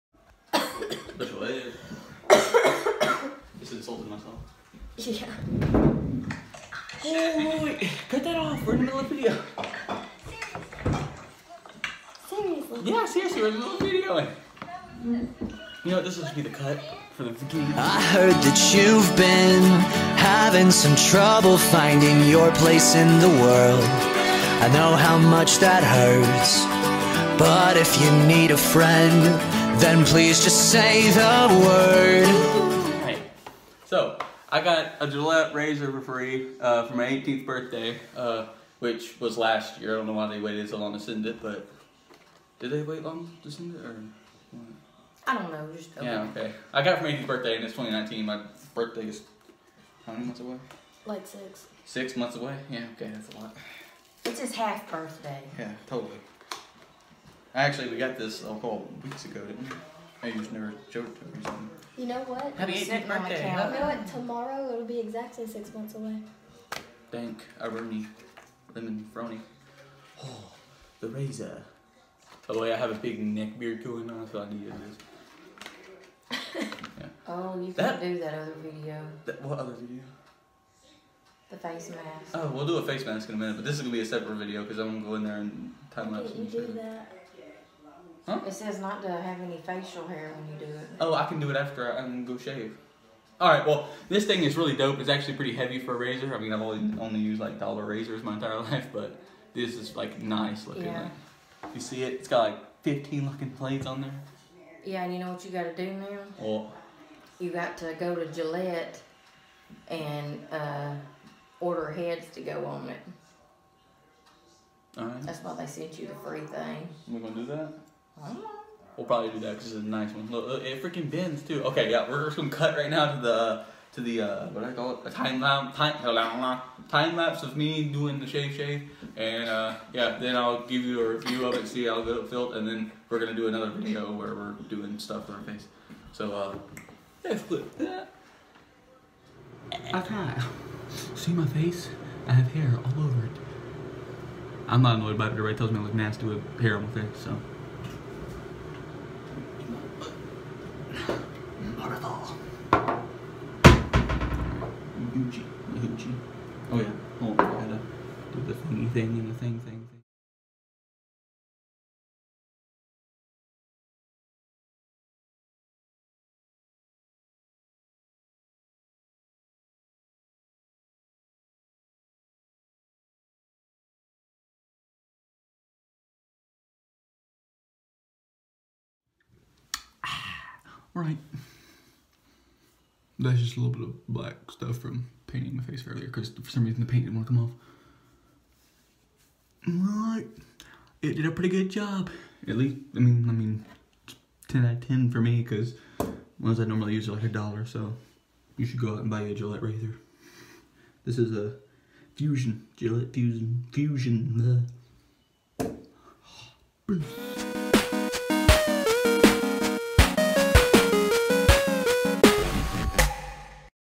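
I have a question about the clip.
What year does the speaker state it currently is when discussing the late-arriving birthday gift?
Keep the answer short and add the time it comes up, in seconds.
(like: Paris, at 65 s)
2019, at 47 s.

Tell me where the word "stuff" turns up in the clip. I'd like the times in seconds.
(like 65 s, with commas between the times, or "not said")
134 s, 184 s.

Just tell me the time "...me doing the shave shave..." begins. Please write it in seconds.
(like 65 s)
127 s.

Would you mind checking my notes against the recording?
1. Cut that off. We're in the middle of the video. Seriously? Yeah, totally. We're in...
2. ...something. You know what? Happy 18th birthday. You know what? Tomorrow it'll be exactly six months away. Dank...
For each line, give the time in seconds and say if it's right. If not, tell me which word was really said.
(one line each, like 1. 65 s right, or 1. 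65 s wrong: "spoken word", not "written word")
1. 8 s wrong: "seriously", not "totally"
2. 61 s right.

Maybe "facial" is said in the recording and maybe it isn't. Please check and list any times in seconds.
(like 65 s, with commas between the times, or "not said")
89 s.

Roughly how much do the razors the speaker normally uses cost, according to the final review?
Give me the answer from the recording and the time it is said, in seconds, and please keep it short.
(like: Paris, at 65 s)
a dollar, at 197 s.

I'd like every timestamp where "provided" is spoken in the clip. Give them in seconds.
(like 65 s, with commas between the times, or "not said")
not said.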